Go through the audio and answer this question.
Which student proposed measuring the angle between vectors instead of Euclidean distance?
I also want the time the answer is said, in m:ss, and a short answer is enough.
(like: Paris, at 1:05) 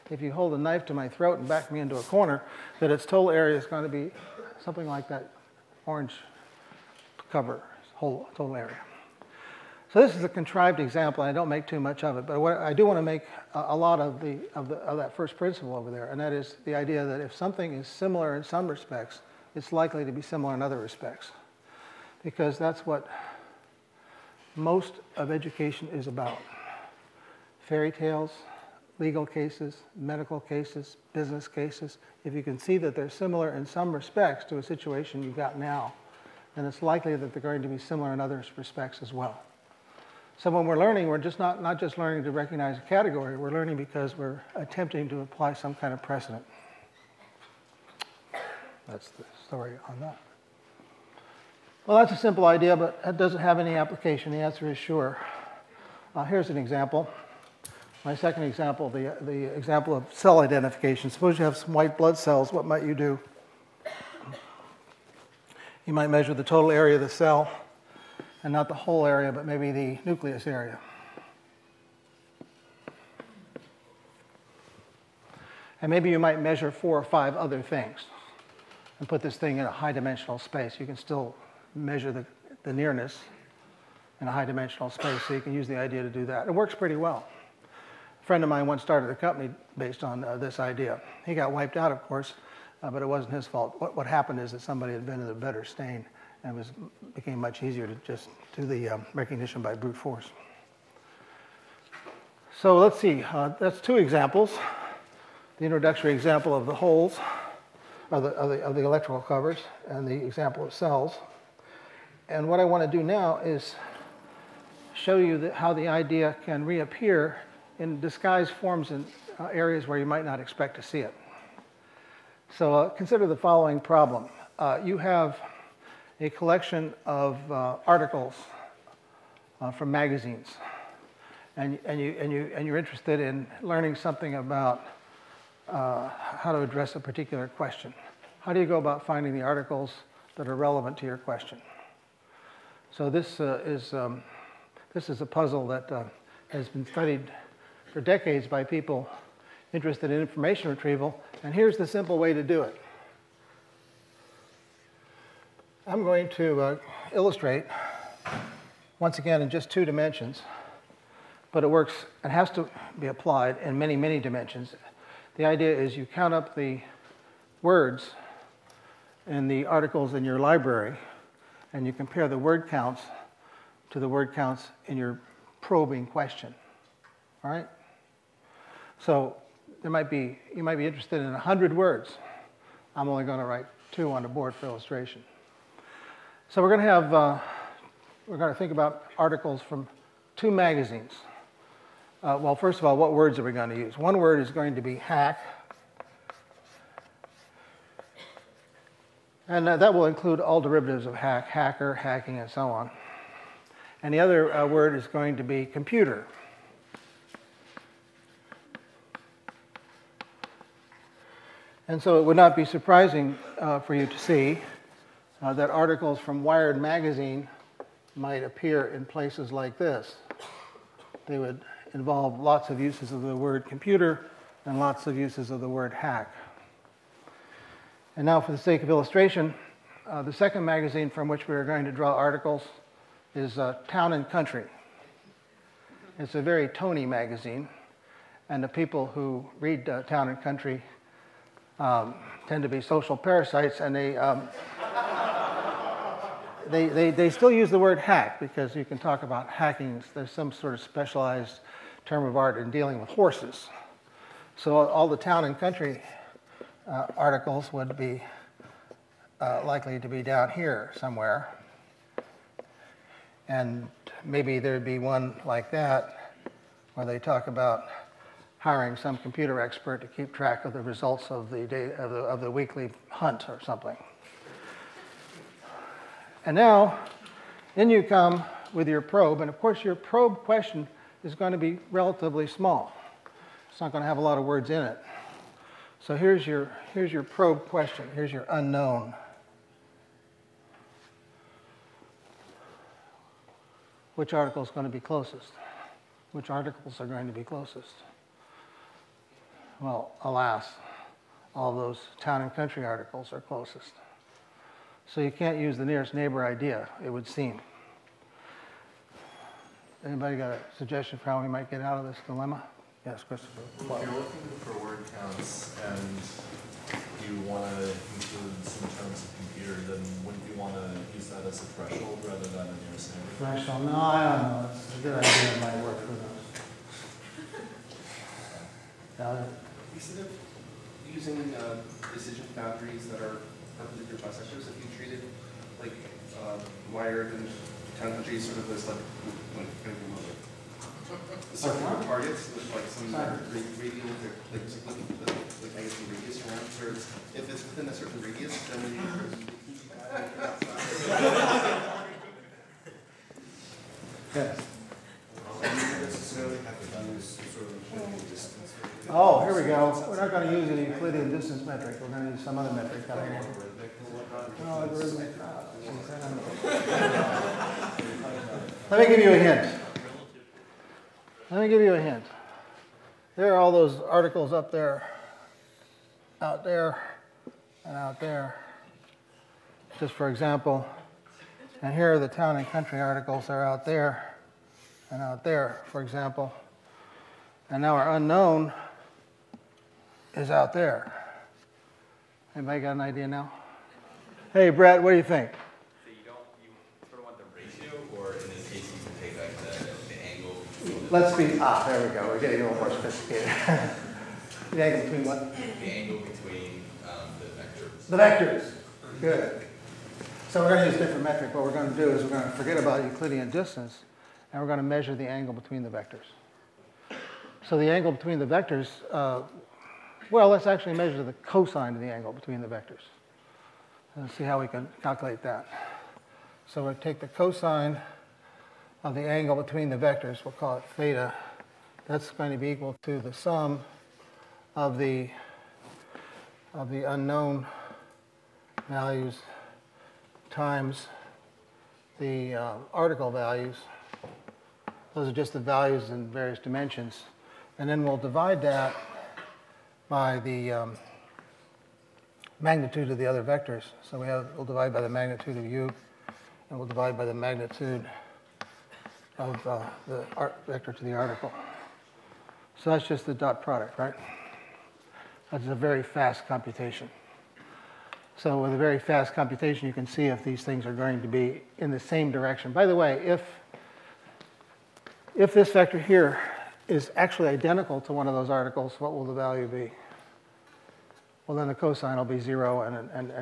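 Brett, at 6:34.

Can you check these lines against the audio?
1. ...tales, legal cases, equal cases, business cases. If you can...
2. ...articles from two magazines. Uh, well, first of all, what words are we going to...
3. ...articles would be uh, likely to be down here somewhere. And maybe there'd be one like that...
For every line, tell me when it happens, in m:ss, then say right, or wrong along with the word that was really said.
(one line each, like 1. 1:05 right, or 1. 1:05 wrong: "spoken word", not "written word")
1. 0:27 wrong: "medical", not "equal"
2. 3:09 right
3. 4:17 right.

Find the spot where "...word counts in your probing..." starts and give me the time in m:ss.
2:54.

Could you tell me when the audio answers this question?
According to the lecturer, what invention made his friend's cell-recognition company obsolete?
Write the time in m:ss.
1:35.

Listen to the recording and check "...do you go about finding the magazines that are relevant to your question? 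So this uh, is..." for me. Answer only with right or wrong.
wrong.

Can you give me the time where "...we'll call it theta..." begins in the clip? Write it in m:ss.
7:10.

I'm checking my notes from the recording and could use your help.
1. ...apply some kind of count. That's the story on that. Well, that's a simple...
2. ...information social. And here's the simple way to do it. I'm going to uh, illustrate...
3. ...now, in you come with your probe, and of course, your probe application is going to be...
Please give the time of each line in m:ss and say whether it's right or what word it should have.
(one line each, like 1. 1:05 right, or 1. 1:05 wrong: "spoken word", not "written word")
1. 0:45 wrong: "precedent", not "count"
2. 2:30 wrong: "retrieval", not "social"
3. 4:36 wrong: "question", not "application".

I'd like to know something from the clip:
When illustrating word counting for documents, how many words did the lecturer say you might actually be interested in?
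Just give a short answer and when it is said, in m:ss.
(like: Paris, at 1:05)
100, at 3:01.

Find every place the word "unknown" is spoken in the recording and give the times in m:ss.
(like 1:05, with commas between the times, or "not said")
4:48, 6:28, 7:17.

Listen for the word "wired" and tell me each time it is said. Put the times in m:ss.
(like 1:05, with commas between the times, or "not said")
3:36, 5:36.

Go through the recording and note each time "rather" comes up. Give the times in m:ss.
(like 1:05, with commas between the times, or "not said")
5:22.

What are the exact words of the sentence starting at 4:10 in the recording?
There's some sort of specialized term of art in dealing with horses.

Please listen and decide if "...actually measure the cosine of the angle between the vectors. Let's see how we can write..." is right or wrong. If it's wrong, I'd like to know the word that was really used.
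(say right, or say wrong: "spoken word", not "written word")
wrong: "calculate", not "write".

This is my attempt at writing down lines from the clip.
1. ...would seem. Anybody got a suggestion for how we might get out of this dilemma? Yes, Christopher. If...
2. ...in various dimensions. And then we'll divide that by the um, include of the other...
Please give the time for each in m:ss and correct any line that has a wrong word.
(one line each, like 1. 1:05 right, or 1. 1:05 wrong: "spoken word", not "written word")
1. 5:07 right
2. 7:26 wrong: "magnitude", not "include".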